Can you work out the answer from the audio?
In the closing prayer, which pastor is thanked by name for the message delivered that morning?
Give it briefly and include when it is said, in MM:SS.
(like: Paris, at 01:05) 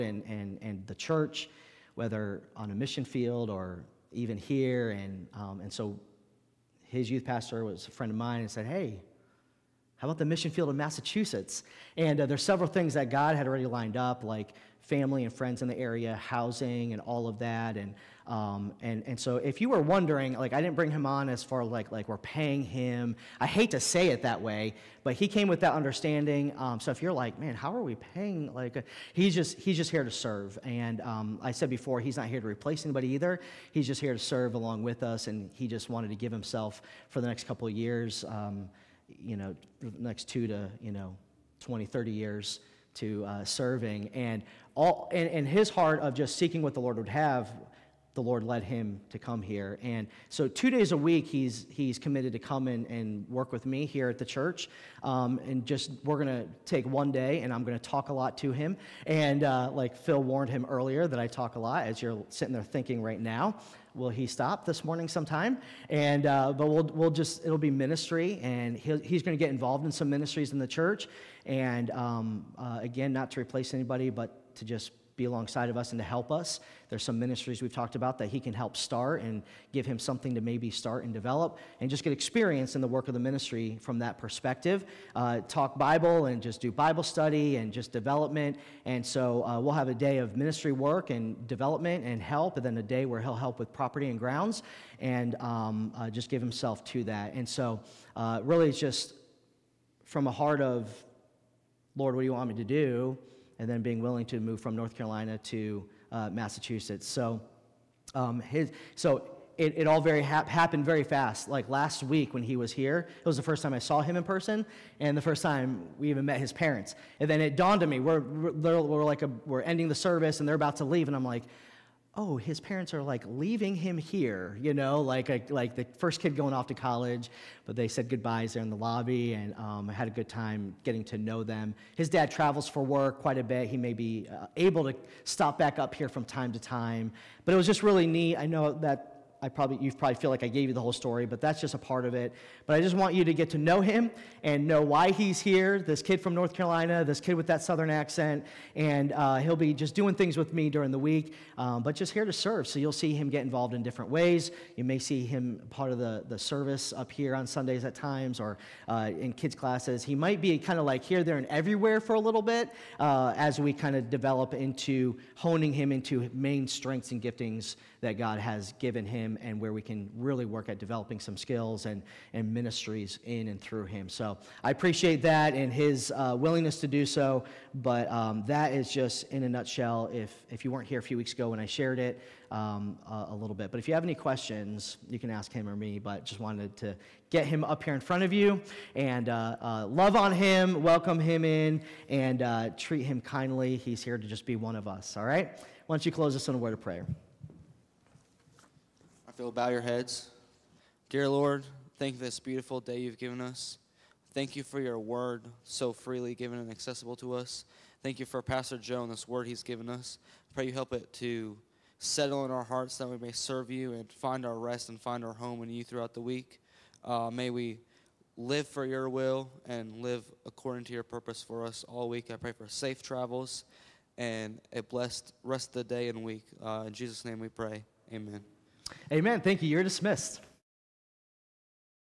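Pastor Joe, at 03:28.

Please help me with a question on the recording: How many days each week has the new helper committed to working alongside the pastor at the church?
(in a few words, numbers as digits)
2.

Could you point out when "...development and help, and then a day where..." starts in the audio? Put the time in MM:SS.
01:31.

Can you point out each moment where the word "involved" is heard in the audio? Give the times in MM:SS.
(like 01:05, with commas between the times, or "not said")
01:09, 02:33.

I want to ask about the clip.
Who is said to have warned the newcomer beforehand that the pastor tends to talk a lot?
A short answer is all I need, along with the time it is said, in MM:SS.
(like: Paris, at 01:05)
Phil, at 00:59.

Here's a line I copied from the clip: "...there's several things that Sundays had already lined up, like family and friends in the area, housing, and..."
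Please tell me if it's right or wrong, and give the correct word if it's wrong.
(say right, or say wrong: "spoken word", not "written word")
wrong: "God", not "Sundays".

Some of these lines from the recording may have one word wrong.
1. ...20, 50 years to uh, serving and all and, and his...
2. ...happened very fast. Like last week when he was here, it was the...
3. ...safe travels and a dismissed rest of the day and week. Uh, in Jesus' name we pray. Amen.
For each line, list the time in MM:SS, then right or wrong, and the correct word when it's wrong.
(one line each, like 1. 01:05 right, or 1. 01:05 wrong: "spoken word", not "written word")
1. 00:41 wrong: "30", not "50"
2. 01:50 right
3. 03:42 wrong: "blessed", not "dismissed".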